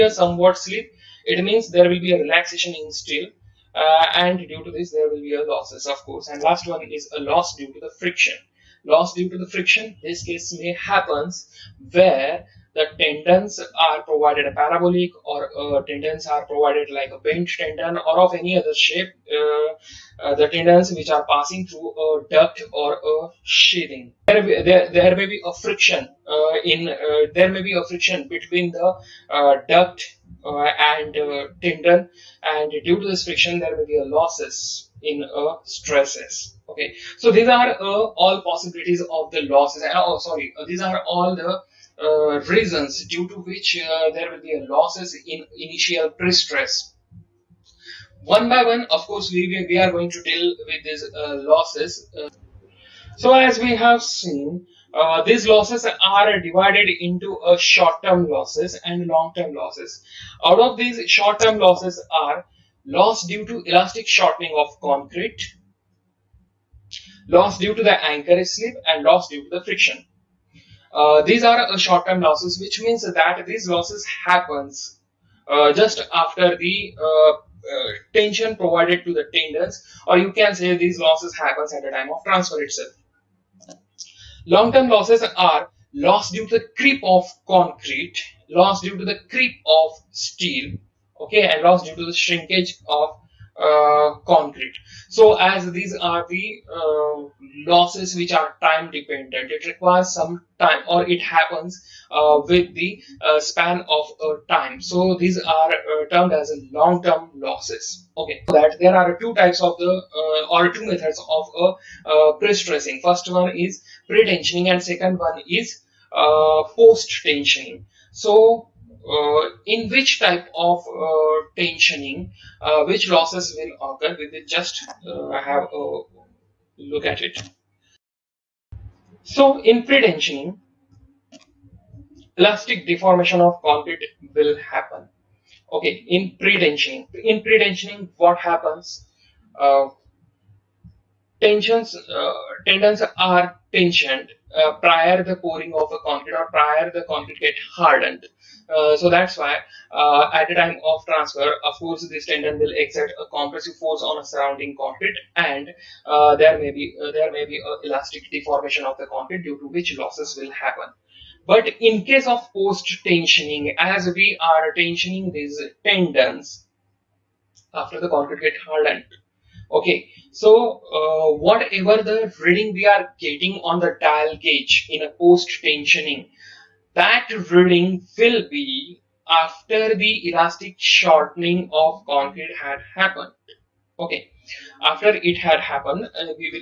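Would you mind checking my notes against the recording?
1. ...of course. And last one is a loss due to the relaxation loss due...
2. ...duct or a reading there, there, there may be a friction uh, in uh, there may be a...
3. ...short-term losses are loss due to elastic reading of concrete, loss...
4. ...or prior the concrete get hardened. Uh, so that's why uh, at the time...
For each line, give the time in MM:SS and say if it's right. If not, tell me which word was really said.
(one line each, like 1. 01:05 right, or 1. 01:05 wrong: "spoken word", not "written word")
1. 00:05 wrong: "friction", not "relaxation"
2. 00:22 wrong: "sheathing", not "reading"
3. 01:01 wrong: "shortening", not "reading"
4. 02:26 right.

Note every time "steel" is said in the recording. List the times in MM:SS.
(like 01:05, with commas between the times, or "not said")
00:02, 01:30.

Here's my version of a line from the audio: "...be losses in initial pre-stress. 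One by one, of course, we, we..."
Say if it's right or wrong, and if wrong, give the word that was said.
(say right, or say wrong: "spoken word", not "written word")
right.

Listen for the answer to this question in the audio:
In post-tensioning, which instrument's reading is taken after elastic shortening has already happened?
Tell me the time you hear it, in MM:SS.
02:54.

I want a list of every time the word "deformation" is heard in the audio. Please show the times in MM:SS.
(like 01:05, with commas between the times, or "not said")
02:12, 02:38.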